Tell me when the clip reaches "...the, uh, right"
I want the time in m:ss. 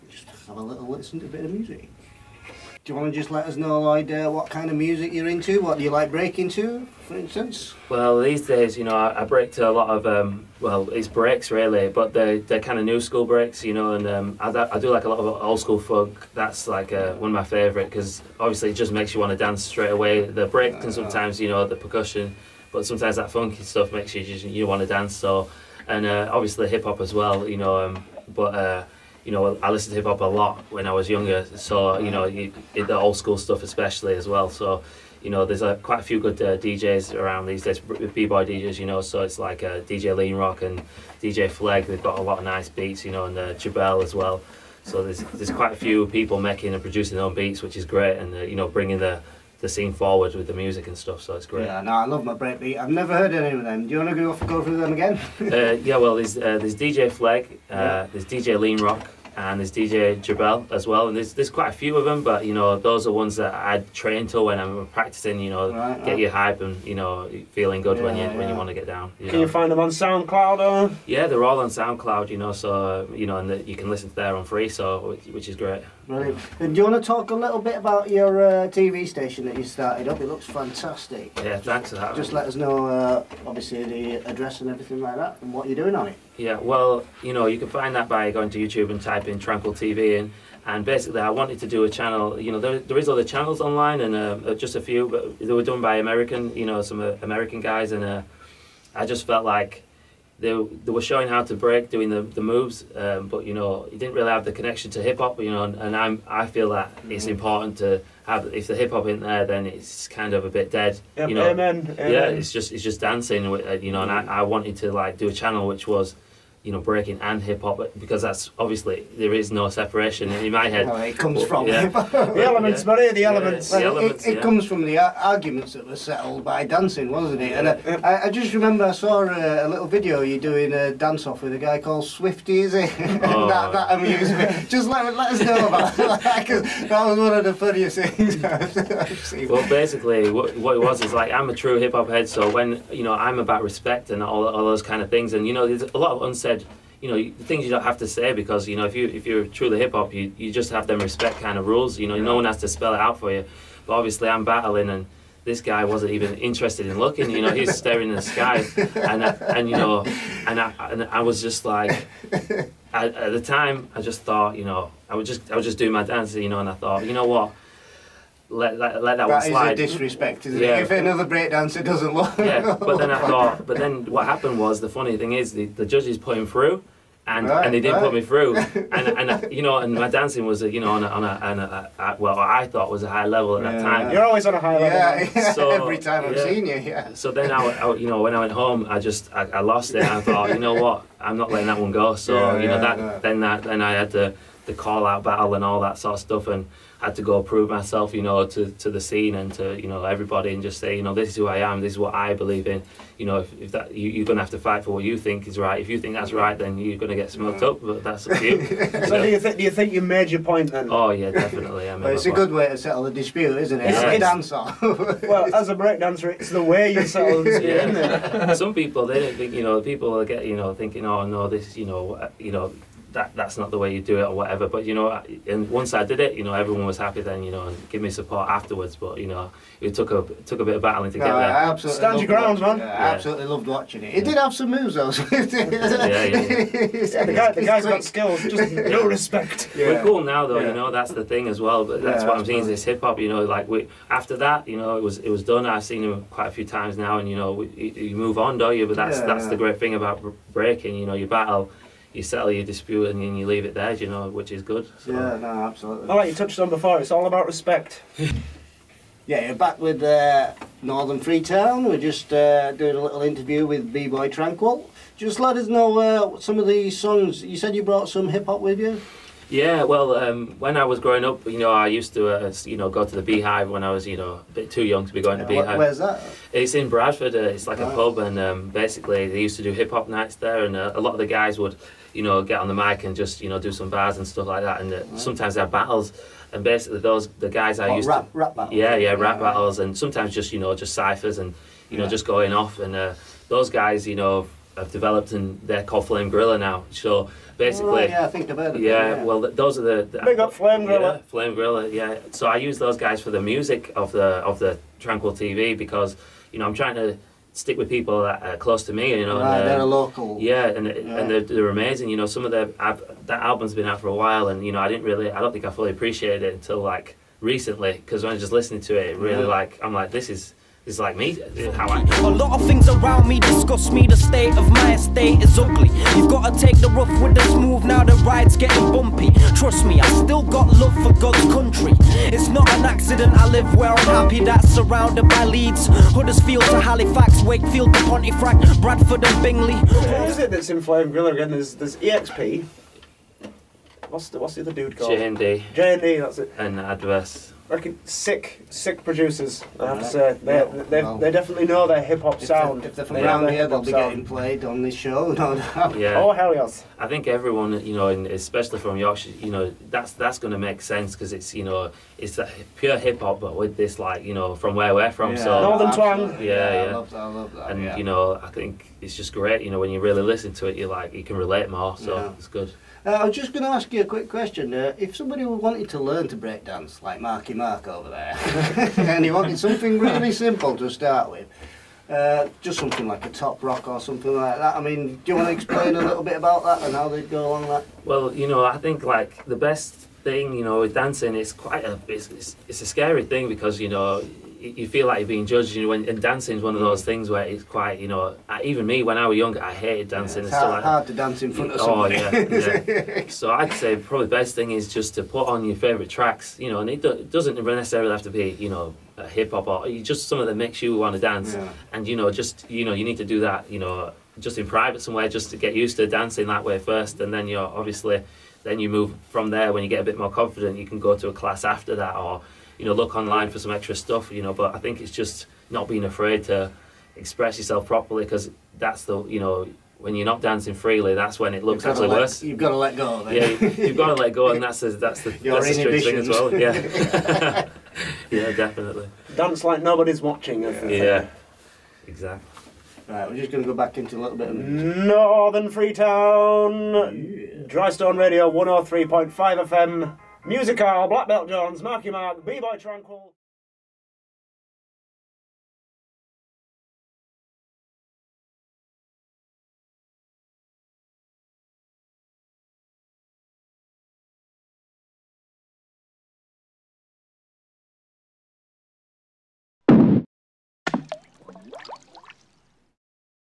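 4:44.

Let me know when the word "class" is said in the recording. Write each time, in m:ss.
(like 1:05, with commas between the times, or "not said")
7:01.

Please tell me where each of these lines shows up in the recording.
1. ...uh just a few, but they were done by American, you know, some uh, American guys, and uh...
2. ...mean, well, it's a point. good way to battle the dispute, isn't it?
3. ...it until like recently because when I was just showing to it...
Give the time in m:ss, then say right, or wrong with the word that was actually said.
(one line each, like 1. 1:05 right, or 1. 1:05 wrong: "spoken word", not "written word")
1. 1:34 right
2. 3:31 wrong: "settle", not "battle"
3. 5:16 wrong: "listening", not "showing".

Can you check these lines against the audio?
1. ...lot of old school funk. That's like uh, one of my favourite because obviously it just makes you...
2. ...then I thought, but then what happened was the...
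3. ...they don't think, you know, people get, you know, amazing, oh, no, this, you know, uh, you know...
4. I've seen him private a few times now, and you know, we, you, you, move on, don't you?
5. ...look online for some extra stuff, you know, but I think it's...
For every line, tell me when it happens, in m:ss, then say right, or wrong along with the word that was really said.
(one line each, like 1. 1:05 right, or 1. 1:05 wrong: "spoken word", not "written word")
1. 0:15 right
2. 2:52 right
3. 3:39 wrong: "thinking", not "amazing"
4. 4:05 wrong: "quite", not "private"
5. 7:02 right.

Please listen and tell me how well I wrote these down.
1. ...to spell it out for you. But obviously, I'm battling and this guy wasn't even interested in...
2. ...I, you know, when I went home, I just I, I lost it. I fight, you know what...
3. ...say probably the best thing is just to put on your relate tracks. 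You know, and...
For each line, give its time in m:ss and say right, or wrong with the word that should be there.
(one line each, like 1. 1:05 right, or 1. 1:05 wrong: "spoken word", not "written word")
1. 2:32 right
2. 3:07 wrong: "thought", not "fight"
3. 6:43 wrong: "favorite", not "relate".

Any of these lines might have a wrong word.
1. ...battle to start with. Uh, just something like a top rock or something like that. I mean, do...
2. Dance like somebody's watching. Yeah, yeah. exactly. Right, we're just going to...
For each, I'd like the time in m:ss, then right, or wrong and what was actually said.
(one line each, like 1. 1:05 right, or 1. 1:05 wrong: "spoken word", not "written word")
1. 6:20 wrong: "simple", not "battle"
2. 7:19 wrong: "nobody", not "somebody".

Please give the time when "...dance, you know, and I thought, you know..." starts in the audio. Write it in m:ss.
2:46.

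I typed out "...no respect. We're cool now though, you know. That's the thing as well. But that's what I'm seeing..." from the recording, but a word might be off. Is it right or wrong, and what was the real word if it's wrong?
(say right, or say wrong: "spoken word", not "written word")
right.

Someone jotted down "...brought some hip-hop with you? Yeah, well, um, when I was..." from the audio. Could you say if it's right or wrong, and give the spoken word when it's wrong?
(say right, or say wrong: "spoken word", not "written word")
right.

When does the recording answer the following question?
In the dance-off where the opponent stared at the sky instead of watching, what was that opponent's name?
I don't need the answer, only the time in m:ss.
2:12.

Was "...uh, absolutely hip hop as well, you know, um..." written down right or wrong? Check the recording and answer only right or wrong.
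wrong.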